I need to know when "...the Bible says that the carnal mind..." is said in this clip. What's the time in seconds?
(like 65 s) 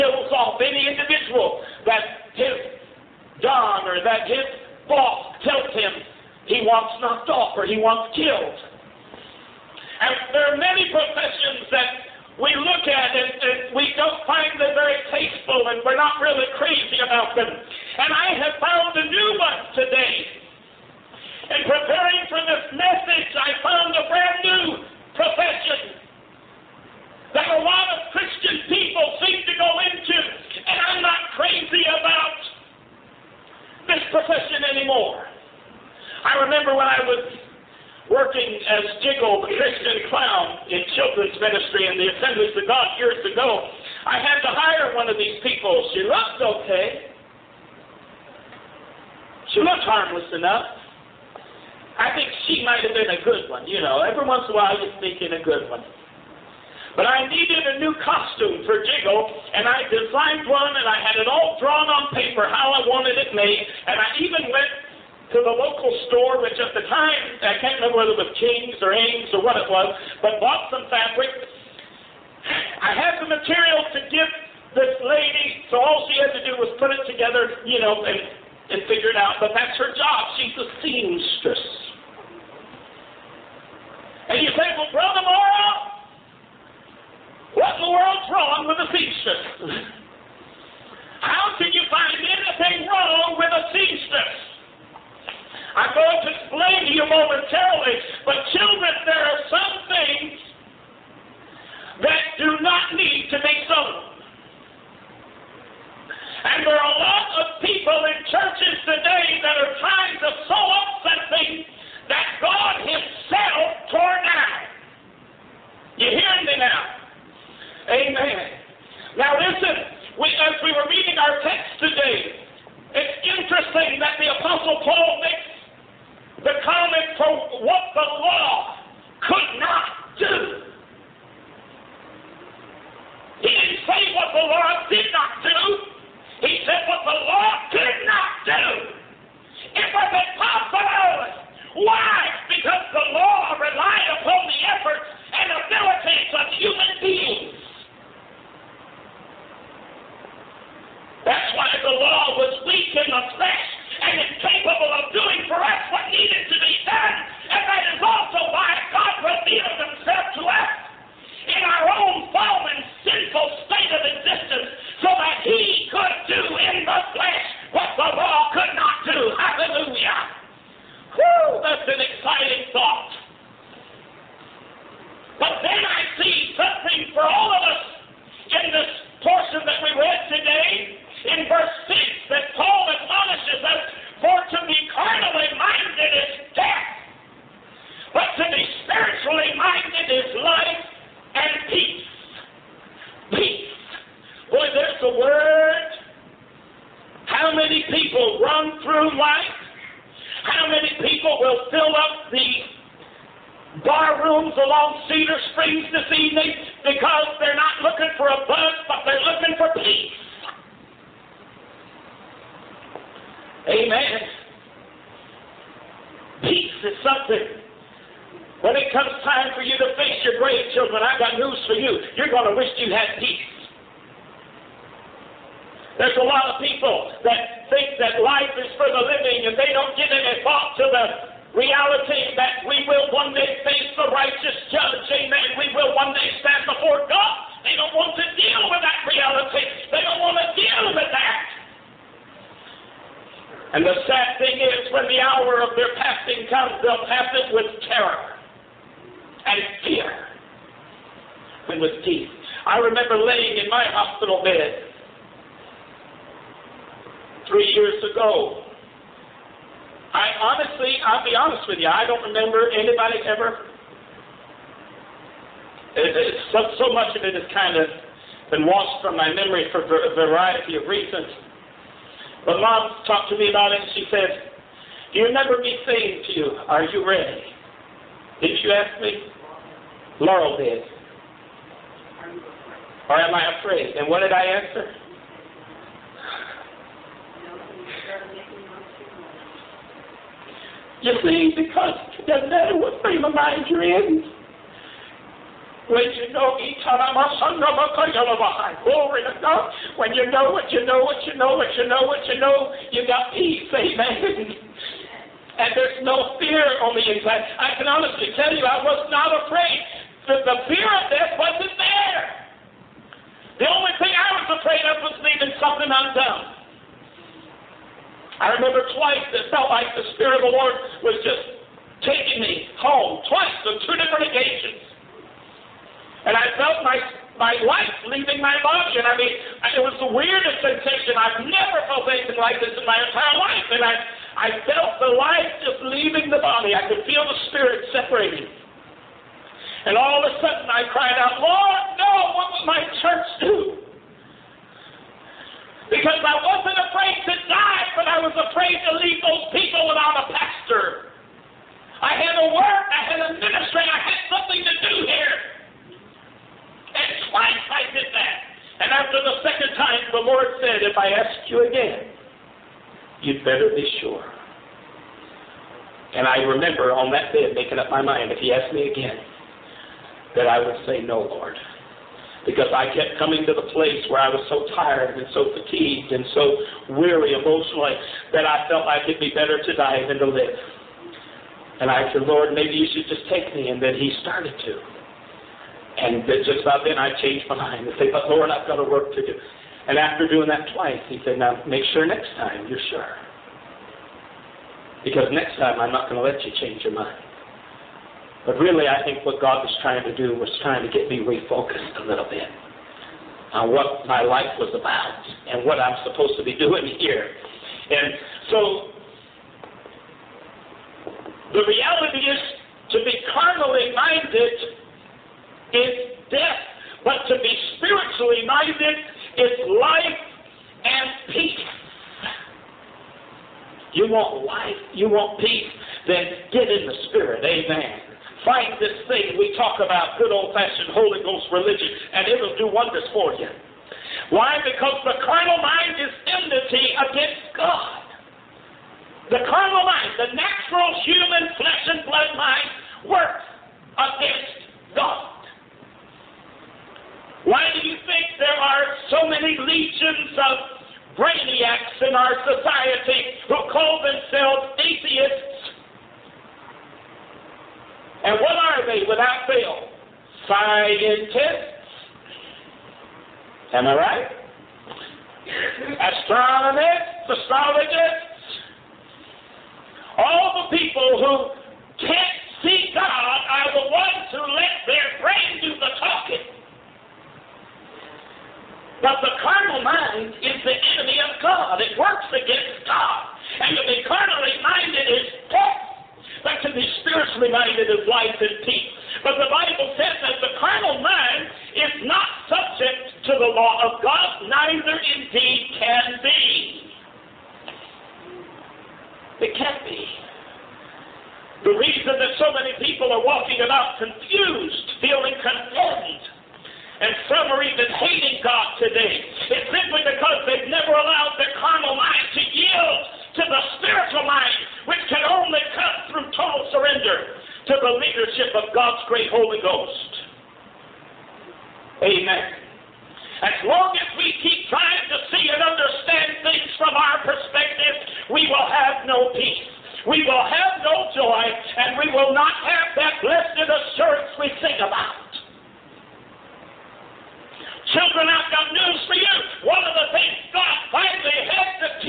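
489 s.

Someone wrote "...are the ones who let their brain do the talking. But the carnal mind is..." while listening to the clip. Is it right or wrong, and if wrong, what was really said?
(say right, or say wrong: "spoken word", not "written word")
right.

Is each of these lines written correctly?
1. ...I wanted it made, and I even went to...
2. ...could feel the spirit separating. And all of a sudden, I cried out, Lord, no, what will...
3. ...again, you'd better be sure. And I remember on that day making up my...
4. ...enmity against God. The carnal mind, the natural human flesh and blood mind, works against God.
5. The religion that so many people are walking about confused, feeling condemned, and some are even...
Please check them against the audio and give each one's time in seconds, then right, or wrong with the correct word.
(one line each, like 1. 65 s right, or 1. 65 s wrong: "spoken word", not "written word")
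1. 62 s right
2. 336 s right
3. 361 s right
4. 436 s right
5. 501 s wrong: "reason", not "religion".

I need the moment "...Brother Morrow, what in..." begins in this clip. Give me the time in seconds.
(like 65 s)
84 s.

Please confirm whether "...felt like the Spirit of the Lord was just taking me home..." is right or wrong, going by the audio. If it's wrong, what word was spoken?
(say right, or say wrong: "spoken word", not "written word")
right.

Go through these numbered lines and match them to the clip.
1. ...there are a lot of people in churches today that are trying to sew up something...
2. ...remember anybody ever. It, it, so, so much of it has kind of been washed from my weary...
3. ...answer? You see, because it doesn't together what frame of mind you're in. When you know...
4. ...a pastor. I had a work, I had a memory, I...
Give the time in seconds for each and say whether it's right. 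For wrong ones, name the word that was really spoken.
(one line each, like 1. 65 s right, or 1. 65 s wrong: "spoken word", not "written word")
1. 106 s right
2. 262 s wrong: "memory", not "weary"
3. 284 s wrong: "matter", not "together"
4. 350 s wrong: "ministry", not "memory".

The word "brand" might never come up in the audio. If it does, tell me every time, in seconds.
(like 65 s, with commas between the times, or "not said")
24 s.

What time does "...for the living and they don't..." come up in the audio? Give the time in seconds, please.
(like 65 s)
228 s.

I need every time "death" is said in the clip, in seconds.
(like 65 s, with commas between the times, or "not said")
311 s, 416 s, 485 s.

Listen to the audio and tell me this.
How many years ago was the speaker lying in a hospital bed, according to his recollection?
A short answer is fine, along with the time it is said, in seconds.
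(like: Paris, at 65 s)
3, at 257 s.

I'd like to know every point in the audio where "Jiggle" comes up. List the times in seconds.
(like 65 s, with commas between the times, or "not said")
38 s, 58 s.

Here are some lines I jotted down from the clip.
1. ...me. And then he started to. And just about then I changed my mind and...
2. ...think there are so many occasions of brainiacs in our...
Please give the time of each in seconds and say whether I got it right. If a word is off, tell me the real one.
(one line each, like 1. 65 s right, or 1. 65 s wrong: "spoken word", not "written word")
1. 383 s right
2. 448 s wrong: "legions", not "occasions".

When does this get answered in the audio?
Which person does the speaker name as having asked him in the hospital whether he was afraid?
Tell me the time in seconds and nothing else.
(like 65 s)
280 s.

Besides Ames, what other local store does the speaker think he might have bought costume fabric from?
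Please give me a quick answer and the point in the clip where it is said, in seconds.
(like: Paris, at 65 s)
King's, at 68 s.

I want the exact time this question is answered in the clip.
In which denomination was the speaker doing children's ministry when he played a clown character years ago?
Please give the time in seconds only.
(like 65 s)
42 s.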